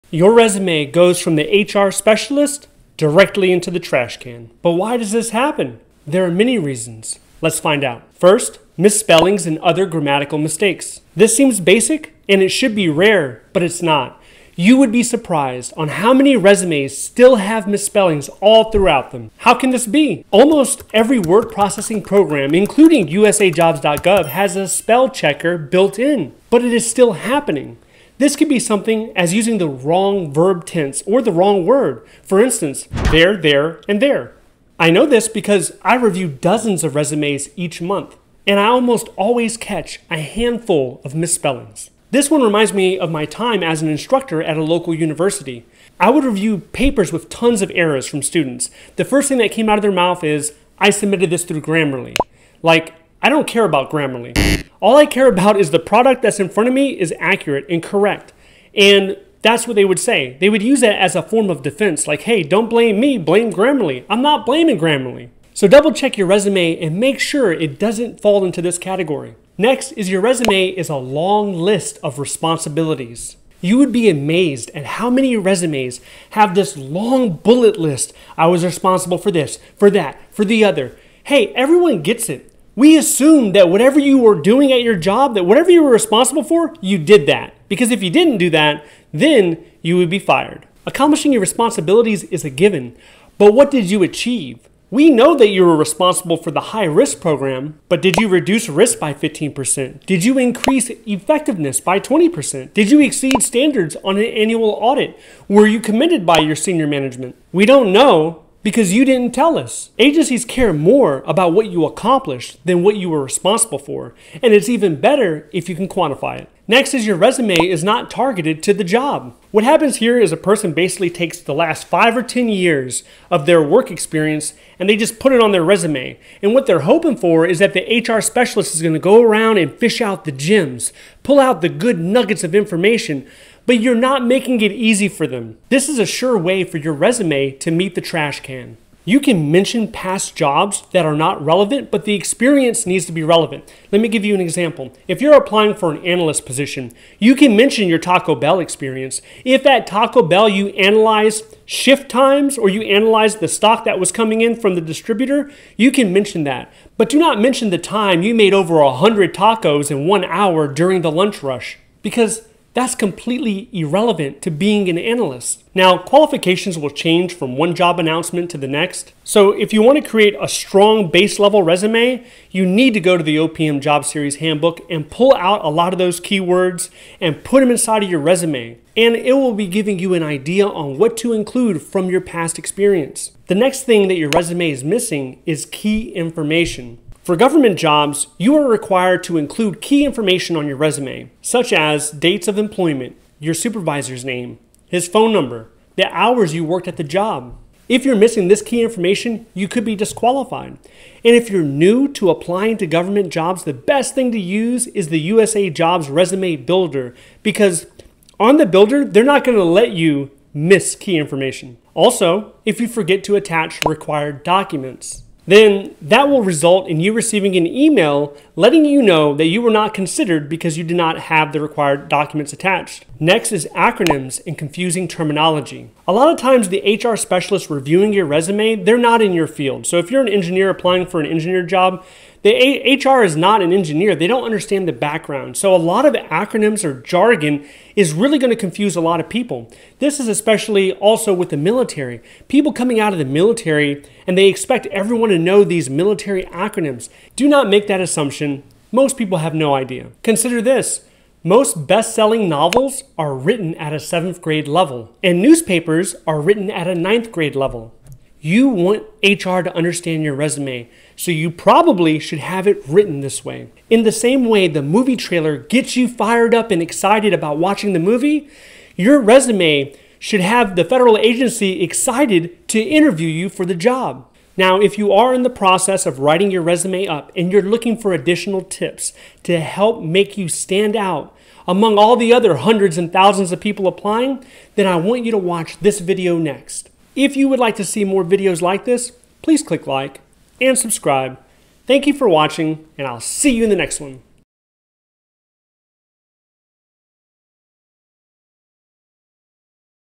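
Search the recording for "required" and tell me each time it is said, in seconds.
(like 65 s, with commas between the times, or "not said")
188 s, 213 s, 221 s.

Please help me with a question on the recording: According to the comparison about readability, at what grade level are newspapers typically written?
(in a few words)
Ninth grade.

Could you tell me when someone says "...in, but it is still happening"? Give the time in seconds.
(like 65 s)
25 s.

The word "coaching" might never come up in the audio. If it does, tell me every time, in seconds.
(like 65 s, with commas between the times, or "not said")
not said.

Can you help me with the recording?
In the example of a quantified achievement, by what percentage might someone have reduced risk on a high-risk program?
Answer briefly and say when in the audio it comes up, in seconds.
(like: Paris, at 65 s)
15%, at 99 s.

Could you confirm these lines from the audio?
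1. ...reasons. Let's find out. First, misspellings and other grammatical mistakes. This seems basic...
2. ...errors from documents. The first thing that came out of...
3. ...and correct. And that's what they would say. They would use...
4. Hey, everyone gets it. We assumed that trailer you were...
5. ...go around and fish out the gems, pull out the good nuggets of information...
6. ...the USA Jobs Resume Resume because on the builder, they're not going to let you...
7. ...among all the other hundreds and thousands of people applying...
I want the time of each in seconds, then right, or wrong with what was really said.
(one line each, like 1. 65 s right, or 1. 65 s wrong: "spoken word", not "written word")
1. 6 s right
2. 47 s wrong: "students", not "documents"
3. 57 s right
4. 81 s wrong: "whatever", not "trailer"
5. 128 s right
6. 205 s wrong: "Builder", not "Resume"
7. 281 s right.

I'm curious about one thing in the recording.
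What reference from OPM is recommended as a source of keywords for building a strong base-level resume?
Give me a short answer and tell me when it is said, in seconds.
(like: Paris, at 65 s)
Job Series Handbook, at 173 s.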